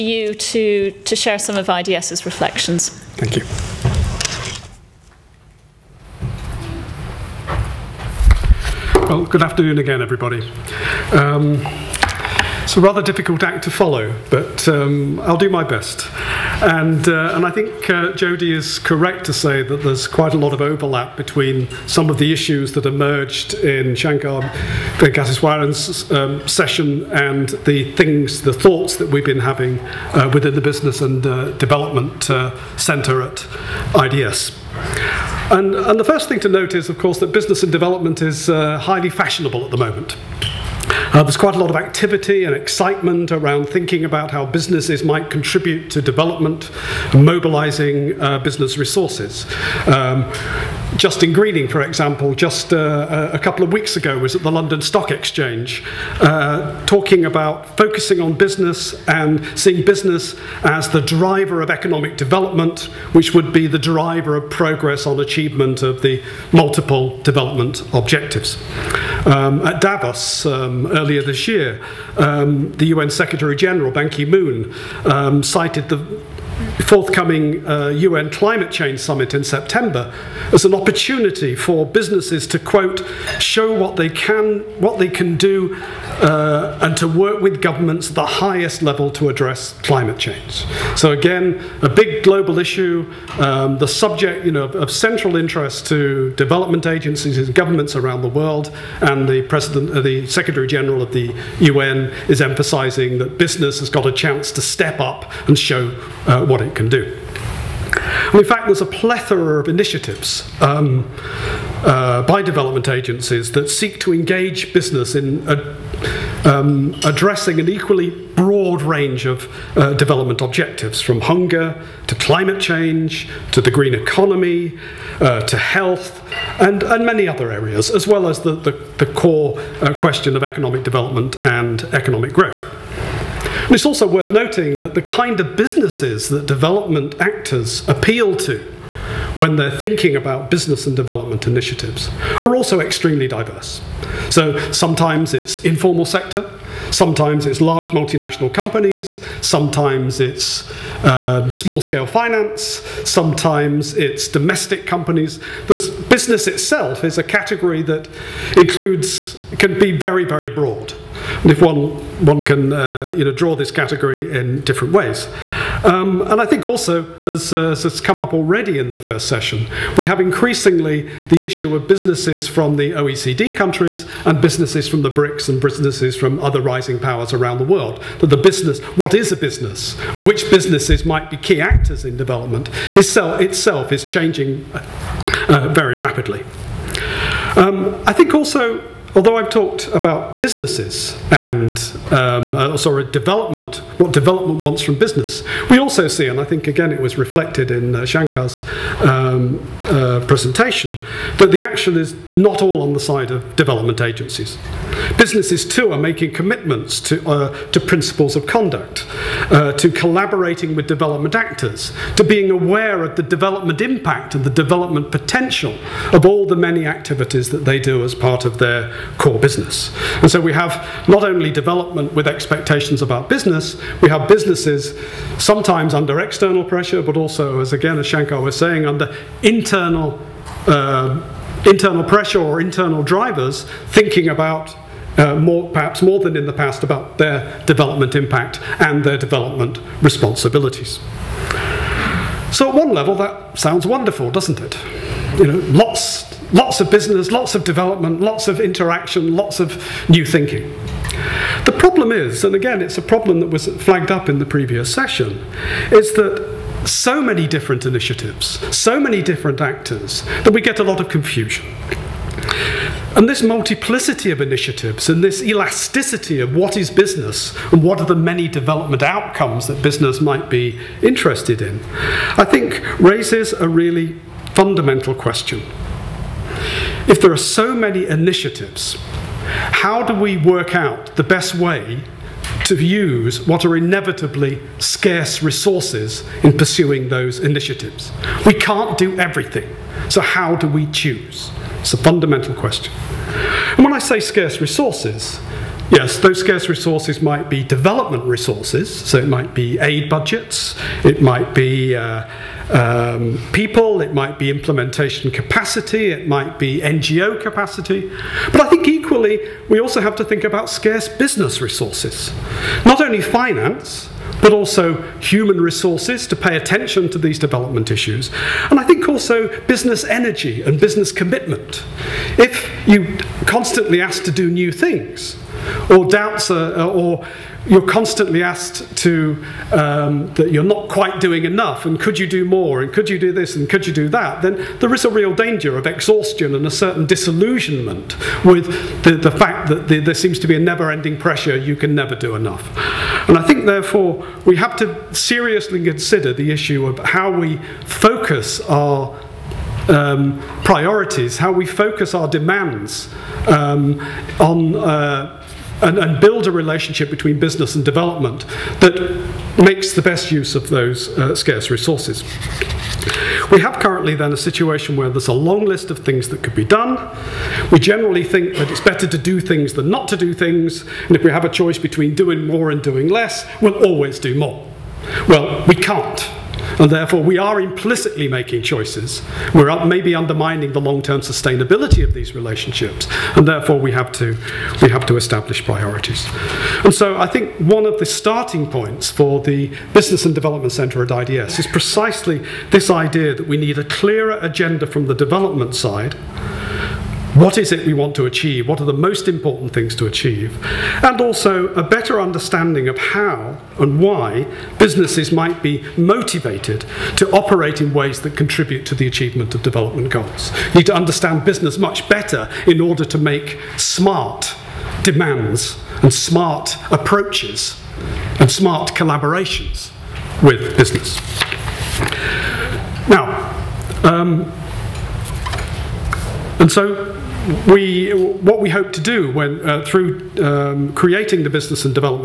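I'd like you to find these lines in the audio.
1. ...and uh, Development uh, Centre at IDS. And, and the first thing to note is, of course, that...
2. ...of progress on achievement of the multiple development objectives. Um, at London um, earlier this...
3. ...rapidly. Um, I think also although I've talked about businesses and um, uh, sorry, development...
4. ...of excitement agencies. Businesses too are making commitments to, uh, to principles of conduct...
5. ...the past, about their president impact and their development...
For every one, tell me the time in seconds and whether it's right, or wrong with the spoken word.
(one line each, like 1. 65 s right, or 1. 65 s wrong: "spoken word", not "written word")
1. 31 s right
2. 64 s wrong: "Davos", not "London"
3. 185 s right
4. 203 s wrong: "development", not "excitement"
5. 236 s wrong: "development", not "president".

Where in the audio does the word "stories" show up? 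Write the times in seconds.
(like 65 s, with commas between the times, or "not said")
not said.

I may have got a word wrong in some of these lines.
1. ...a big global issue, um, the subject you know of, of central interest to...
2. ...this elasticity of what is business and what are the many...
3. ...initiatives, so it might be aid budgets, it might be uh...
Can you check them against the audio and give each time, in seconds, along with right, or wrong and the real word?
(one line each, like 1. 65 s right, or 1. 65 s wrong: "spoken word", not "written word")
1. 91 s right
2. 265 s right
3. 298 s wrong: "resources", not "initiatives".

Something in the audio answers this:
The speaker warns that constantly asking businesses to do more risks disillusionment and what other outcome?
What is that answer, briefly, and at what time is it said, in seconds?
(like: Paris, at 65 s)
exhaustion, at 335 s.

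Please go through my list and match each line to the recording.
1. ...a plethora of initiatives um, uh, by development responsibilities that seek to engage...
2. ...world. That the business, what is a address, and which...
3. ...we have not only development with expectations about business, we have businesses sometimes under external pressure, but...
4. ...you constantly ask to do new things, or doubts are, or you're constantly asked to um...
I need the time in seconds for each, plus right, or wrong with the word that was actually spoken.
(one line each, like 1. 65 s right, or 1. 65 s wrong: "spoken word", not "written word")
1. 108 s wrong: "agencies", not "responsibilities"
2. 177 s wrong: "business", not "address"
3. 220 s right
4. 322 s right.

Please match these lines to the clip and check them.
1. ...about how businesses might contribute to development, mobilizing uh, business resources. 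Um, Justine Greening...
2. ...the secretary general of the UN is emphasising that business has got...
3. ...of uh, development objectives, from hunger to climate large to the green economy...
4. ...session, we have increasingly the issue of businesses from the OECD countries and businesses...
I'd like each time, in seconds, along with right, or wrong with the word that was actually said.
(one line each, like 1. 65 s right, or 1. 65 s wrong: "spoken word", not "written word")
1. 44 s right
2. 100 s right
3. 119 s wrong: "change", not "large"
4. 169 s right.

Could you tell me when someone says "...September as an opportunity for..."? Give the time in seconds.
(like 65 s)
79 s.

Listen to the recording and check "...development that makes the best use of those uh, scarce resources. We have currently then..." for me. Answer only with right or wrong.
right.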